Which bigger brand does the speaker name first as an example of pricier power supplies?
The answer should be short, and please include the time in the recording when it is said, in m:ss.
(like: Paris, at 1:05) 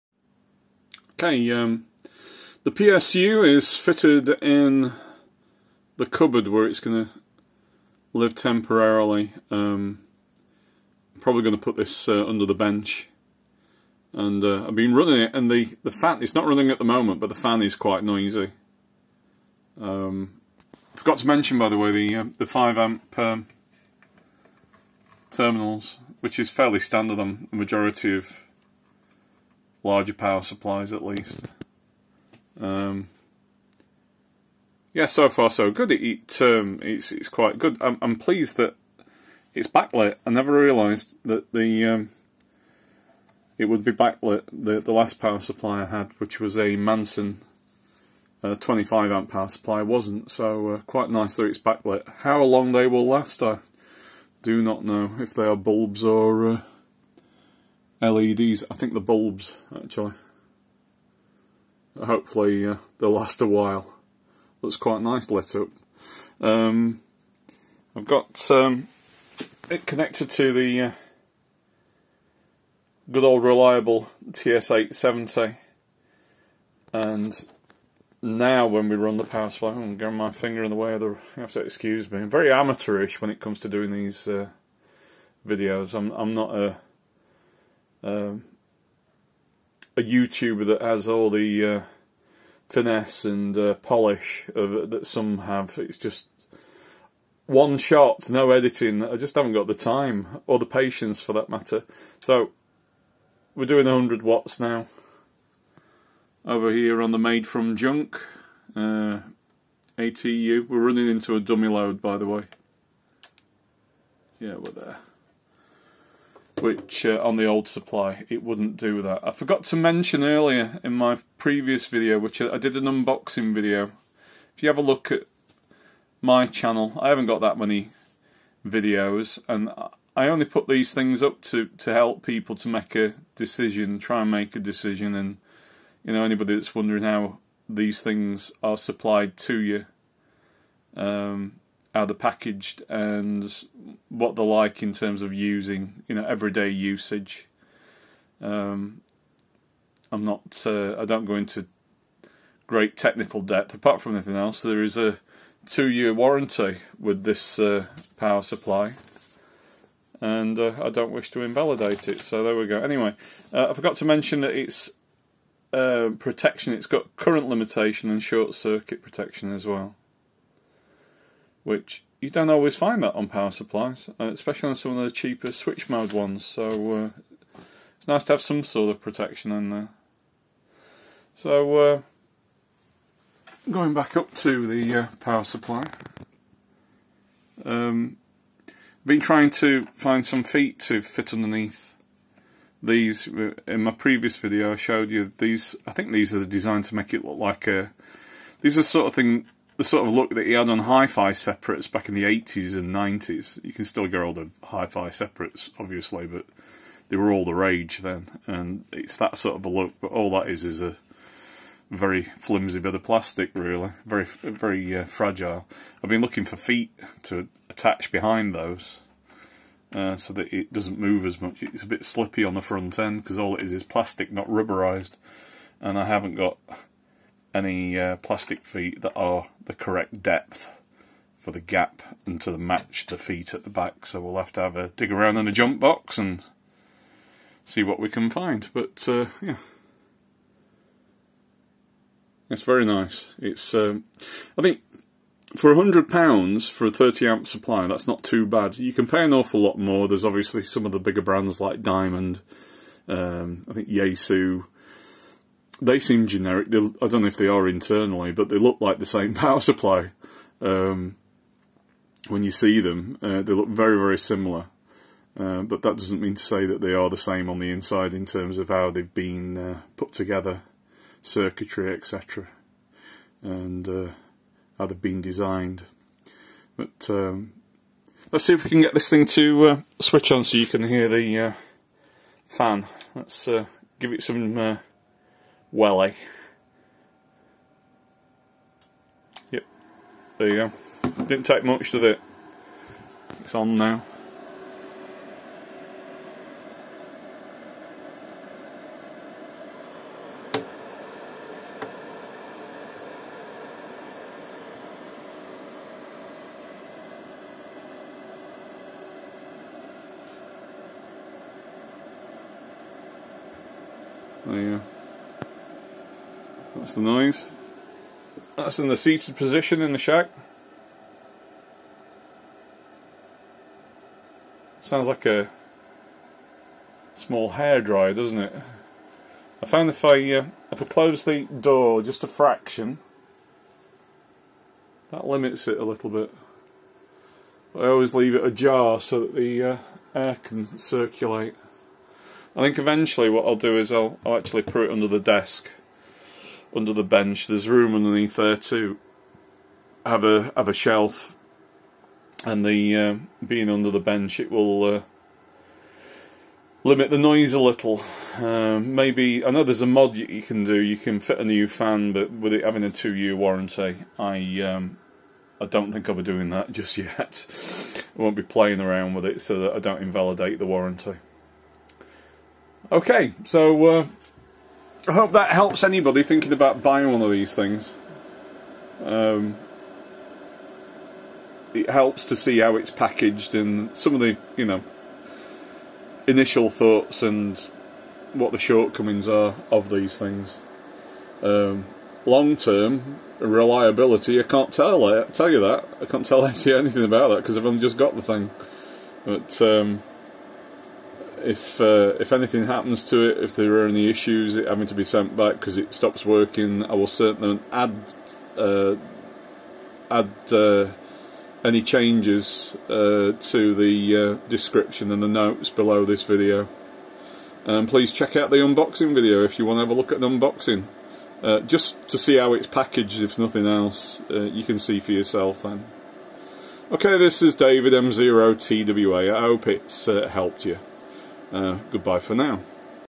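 Diamond, at 4:11.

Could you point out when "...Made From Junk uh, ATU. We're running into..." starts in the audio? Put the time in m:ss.
1:47.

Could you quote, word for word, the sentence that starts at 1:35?
It's just one shot, no editing.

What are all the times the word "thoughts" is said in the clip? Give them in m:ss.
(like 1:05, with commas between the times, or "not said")
6:26.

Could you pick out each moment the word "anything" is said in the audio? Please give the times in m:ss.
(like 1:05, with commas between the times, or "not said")
2:34, 6:36, 6:42.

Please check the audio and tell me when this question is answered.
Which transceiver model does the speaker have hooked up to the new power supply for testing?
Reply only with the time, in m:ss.
1:14.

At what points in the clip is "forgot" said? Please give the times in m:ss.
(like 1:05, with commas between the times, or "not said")
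0:20, 1:59, 2:43.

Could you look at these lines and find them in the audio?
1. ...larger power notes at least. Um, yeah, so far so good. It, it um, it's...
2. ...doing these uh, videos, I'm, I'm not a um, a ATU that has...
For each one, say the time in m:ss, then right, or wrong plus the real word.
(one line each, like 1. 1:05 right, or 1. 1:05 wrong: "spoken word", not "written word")
1. 0:29 wrong: "supplies", not "notes"
2. 1:23 wrong: "YouTuber", not "ATU".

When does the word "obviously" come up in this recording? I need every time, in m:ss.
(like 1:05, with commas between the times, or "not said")
3:25, 4:10.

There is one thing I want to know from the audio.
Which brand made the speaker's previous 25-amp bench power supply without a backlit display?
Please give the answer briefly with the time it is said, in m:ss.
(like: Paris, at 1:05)
Manson, at 0:46.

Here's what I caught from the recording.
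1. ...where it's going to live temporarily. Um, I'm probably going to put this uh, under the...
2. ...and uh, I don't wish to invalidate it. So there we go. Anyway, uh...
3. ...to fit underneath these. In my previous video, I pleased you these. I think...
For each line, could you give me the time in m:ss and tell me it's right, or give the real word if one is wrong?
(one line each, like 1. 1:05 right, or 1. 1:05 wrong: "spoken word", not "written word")
1. 0:06 right
2. 2:40 right
3. 3:10 wrong: "showed", not "pleased".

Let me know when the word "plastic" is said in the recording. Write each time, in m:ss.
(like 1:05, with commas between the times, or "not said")
3:33, 3:43, 3:48.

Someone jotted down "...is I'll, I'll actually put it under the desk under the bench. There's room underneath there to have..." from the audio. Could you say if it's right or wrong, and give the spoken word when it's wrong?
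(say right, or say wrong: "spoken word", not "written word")
right.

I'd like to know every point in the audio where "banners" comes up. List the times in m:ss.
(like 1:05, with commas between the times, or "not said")
not said.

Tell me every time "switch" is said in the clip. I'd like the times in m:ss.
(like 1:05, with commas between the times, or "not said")
2:55, 4:40.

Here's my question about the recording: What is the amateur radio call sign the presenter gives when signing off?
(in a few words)
M0TWA.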